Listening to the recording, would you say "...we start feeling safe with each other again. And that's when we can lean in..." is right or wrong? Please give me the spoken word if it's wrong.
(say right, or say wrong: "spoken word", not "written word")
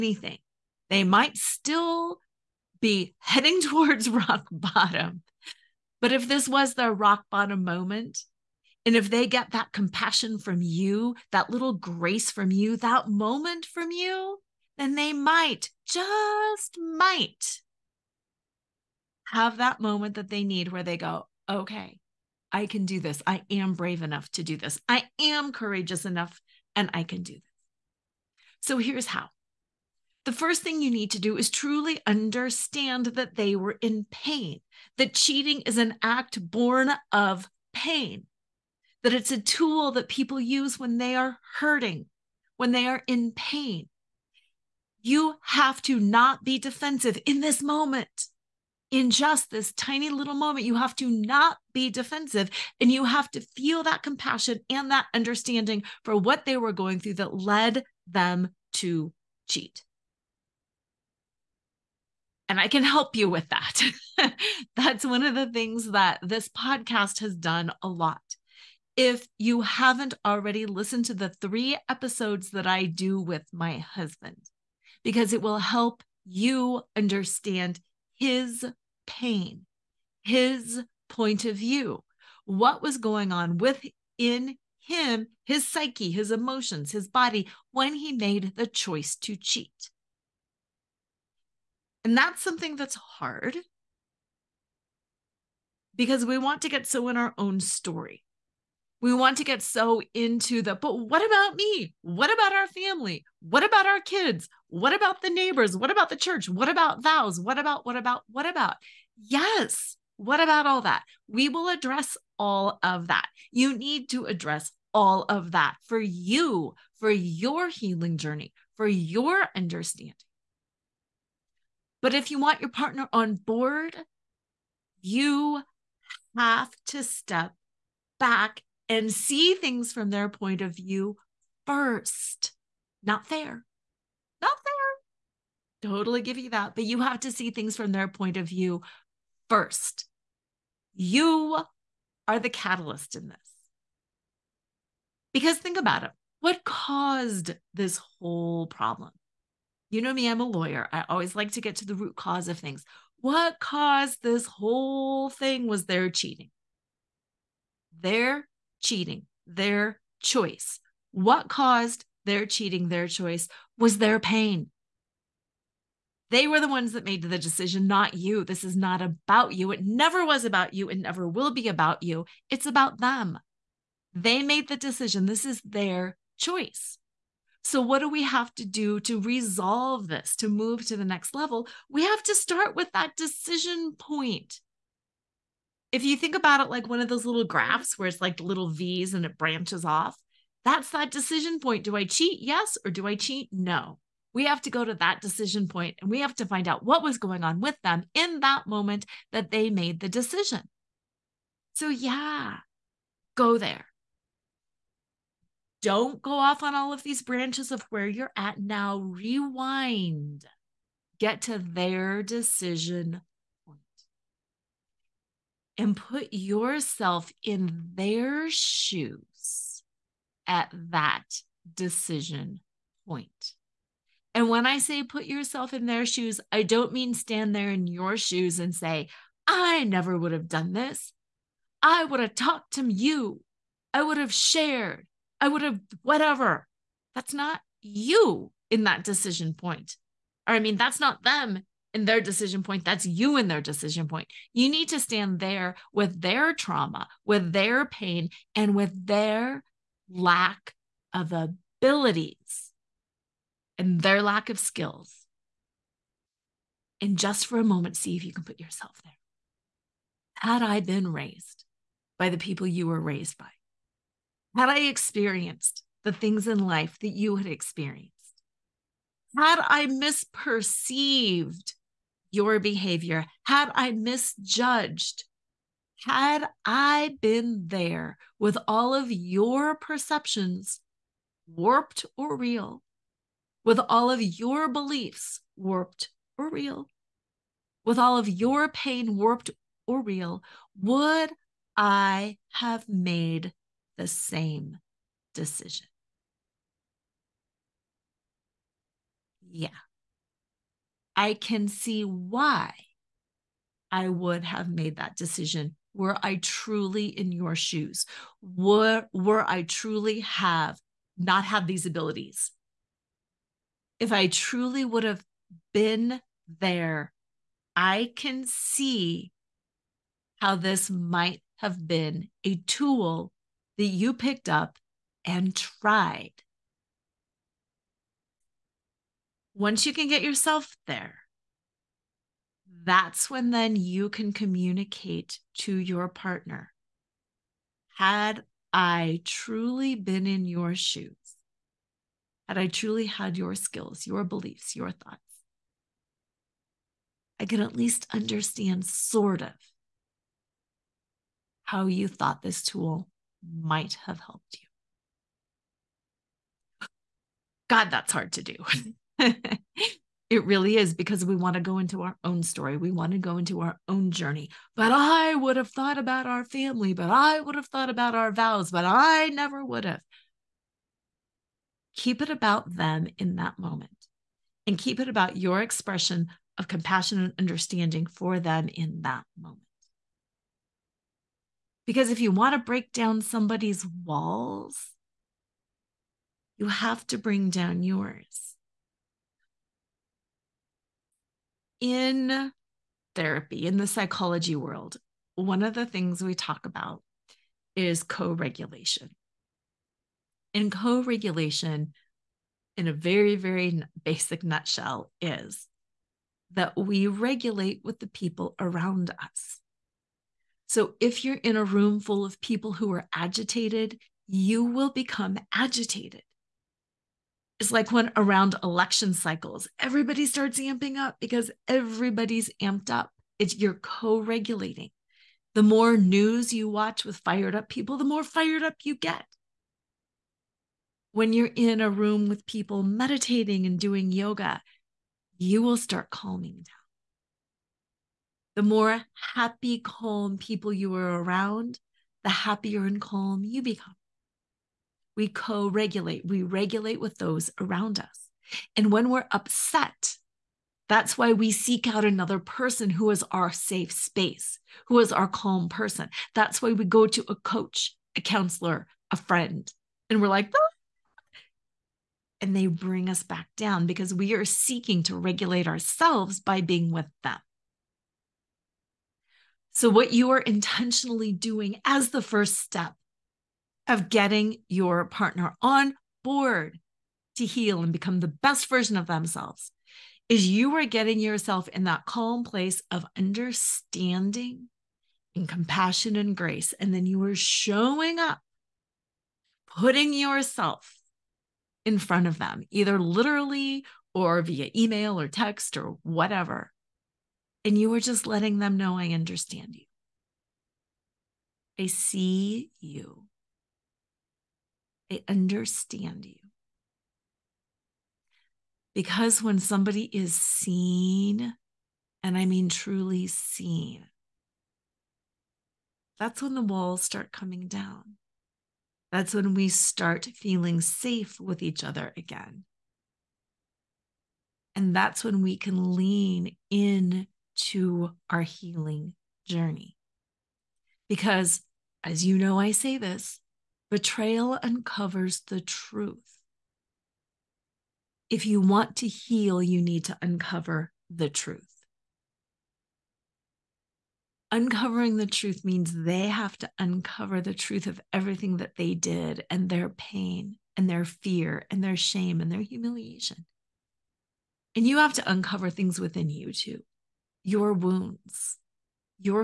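right.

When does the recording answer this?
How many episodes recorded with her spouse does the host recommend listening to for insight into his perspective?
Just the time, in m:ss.
1:11.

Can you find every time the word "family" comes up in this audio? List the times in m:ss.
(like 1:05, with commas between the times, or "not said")
1:42, 6:06.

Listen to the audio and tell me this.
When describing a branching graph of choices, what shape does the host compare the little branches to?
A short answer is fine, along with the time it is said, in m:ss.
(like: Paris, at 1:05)
V's, at 3:08.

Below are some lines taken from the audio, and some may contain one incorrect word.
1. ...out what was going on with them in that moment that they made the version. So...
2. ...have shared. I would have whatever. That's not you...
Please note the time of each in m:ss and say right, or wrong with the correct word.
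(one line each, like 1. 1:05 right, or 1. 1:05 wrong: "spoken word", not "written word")
1. 3:16 wrong: "decision", not "version"
2. 3:54 right.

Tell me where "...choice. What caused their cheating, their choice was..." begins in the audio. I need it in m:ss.
2:40.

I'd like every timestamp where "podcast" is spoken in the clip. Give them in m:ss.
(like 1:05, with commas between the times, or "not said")
1:06.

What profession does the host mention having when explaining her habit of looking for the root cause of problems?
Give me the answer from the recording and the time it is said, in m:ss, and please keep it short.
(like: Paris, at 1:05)
Lawyer, at 2:30.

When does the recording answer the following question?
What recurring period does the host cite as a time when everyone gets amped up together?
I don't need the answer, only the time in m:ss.
6:58.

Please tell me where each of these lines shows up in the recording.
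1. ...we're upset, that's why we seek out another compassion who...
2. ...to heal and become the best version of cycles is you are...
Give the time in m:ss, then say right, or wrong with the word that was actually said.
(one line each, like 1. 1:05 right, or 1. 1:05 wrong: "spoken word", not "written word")
1. 7:29 wrong: "person", not "compassion"
2. 7:57 wrong: "themselves", not "cycles".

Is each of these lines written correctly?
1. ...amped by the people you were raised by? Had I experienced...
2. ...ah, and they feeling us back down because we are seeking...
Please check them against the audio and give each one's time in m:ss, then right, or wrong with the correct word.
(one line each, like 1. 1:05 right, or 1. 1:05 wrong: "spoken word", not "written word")
1. 4:21 wrong: "raised", not "amped"
2. 7:40 wrong: "bring", not "feeling".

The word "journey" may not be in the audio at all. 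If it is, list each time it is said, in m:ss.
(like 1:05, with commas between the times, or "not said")
1:58, 6:04, 8:49.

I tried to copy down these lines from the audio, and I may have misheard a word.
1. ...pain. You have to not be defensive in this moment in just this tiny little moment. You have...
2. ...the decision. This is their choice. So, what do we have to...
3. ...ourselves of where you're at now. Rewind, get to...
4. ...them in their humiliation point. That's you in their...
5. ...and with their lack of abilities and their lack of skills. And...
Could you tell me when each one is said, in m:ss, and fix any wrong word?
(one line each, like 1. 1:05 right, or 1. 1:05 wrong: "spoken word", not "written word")
1. 0:43 right
2. 2:54 right
3. 3:27 wrong: "branches", not "ourselves"
4. 4:01 wrong: "decision", not "humiliation"
5. 4:08 right.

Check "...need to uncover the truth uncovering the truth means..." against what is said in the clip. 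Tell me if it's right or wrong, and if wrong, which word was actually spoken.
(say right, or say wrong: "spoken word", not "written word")
right.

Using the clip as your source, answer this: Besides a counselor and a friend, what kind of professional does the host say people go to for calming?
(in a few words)
Coach.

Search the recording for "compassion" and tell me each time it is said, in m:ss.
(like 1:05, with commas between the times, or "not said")
0:09, 0:54, 6:16, 8:05.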